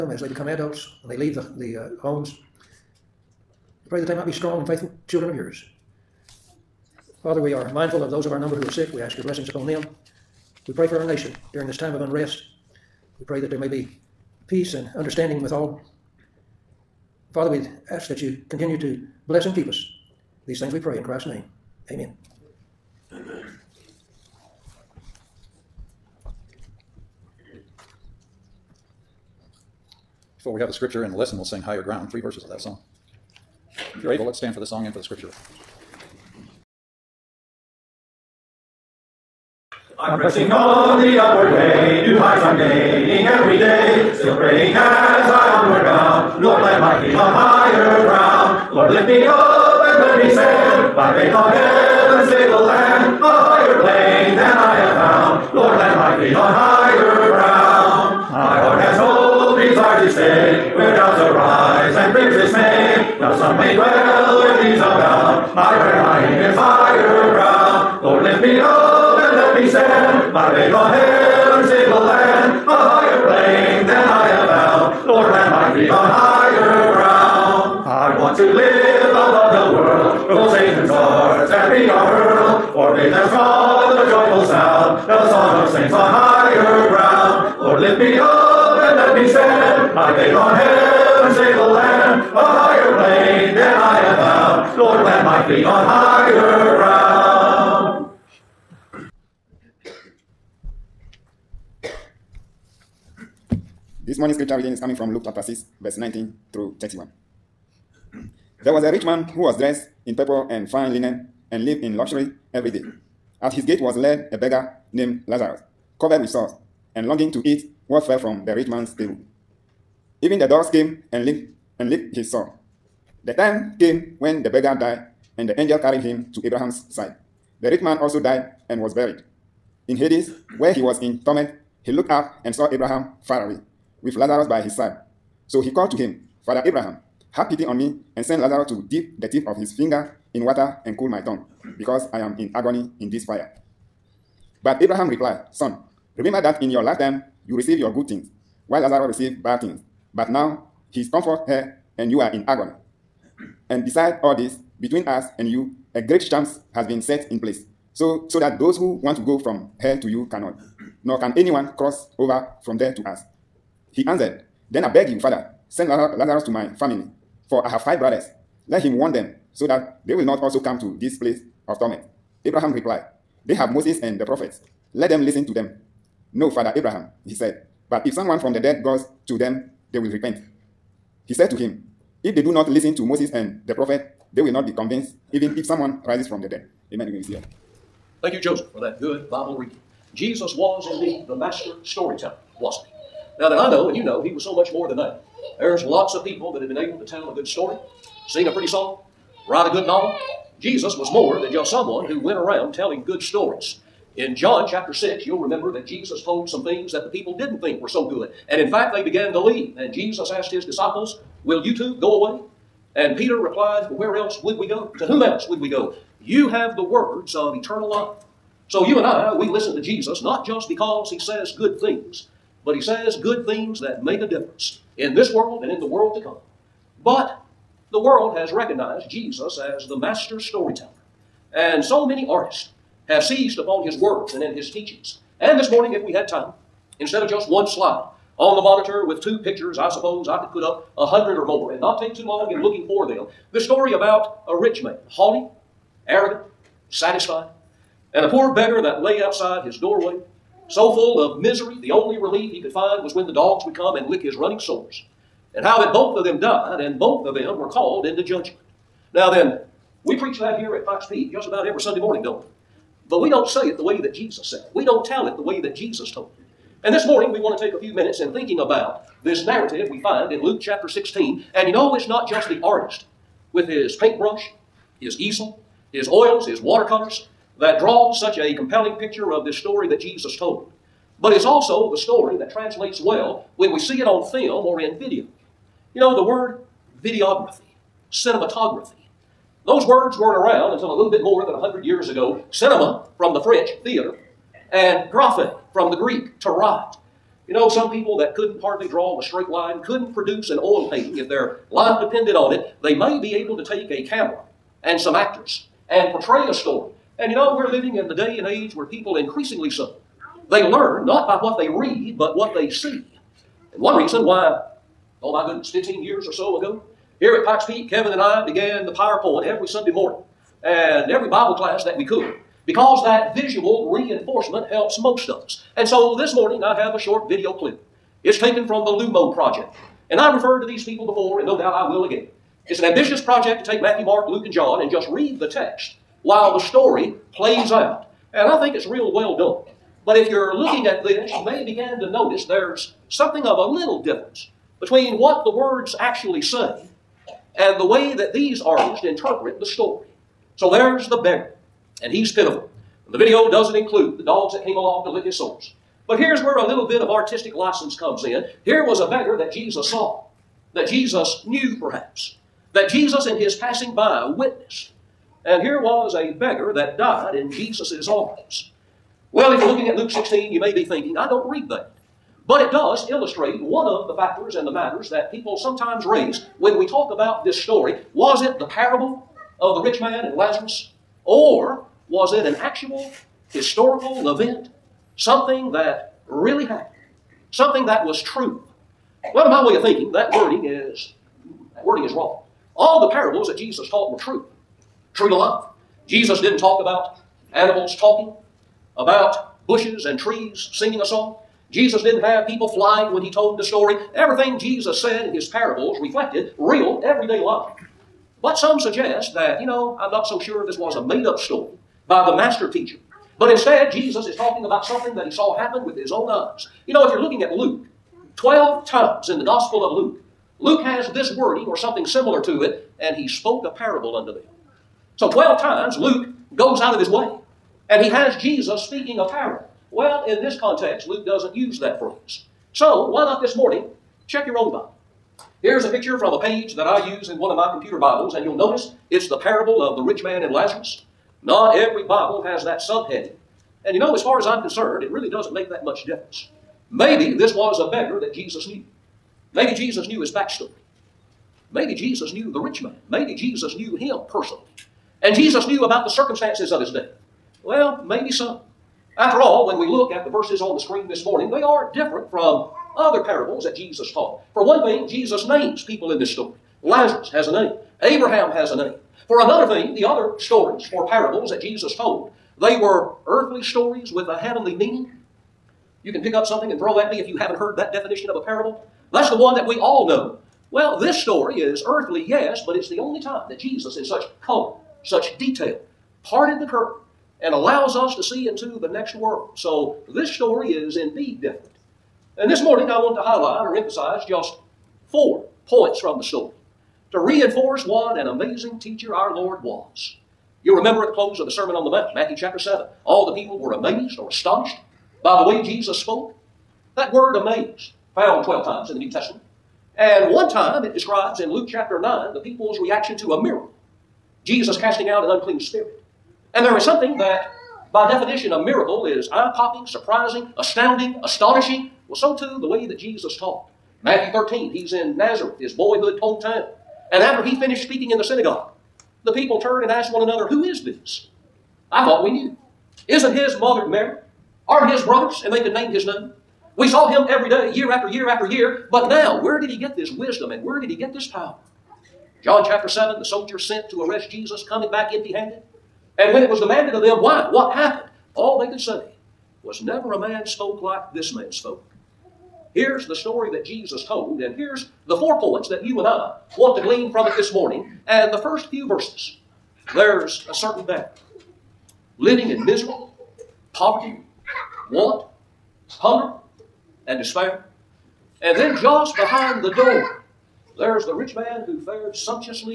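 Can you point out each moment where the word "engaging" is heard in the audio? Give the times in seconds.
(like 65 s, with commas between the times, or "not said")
not said.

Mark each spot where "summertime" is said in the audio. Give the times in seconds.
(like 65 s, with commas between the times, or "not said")
not said.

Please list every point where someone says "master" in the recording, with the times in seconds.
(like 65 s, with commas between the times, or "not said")
191 s, 229 s, 412 s.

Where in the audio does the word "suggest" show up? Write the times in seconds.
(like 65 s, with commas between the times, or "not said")
408 s.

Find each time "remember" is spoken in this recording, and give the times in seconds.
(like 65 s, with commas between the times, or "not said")
146 s, 205 s, 500 s.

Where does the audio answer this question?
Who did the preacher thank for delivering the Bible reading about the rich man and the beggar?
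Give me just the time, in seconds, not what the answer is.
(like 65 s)
188 s.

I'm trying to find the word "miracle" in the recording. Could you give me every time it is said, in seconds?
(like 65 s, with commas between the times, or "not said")
513 s, 518 s.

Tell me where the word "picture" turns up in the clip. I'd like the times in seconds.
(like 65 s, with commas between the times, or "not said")
239 s, 278 s, 435 s.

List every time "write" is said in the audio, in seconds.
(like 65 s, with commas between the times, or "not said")
199 s, 296 s.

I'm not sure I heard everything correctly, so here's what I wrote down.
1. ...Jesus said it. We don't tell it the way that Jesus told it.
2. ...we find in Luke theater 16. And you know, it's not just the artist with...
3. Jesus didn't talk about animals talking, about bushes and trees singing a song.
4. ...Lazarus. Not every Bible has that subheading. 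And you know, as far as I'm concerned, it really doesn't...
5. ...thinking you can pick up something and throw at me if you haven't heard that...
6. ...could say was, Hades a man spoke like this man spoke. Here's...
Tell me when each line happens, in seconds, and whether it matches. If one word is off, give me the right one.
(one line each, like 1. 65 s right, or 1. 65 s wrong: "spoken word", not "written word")
1. 264 s right
2. 269 s wrong: "chapter", not "theater"
3. 396 s right
4. 440 s right
5. 474 s wrong: "meaning", not "thinking"
6. 548 s wrong: "Never", not "Hades".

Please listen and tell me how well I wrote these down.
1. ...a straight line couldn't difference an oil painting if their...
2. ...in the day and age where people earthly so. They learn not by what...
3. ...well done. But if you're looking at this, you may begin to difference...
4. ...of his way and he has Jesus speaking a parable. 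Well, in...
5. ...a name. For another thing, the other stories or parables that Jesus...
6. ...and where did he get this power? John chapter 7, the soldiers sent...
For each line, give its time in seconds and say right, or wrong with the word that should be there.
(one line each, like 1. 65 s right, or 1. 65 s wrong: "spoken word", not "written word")
1. 299 s wrong: "produce", not "difference"
2. 307 s wrong: "increasingly", not "earthly"
3. 339 s wrong: "notice", not "difference"
4. 426 s right
5. 468 s right
6. 540 s right.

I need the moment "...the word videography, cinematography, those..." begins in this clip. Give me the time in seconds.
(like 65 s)
286 s.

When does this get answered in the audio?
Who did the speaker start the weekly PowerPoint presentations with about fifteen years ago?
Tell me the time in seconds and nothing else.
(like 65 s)
317 s.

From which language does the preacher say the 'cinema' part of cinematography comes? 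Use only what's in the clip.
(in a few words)
French.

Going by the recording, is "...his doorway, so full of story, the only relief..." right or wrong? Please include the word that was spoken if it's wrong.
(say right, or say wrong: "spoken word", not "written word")
wrong: "misery", not "story".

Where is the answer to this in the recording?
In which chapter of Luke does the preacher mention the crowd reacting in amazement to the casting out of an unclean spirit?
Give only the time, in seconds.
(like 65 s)
511 s.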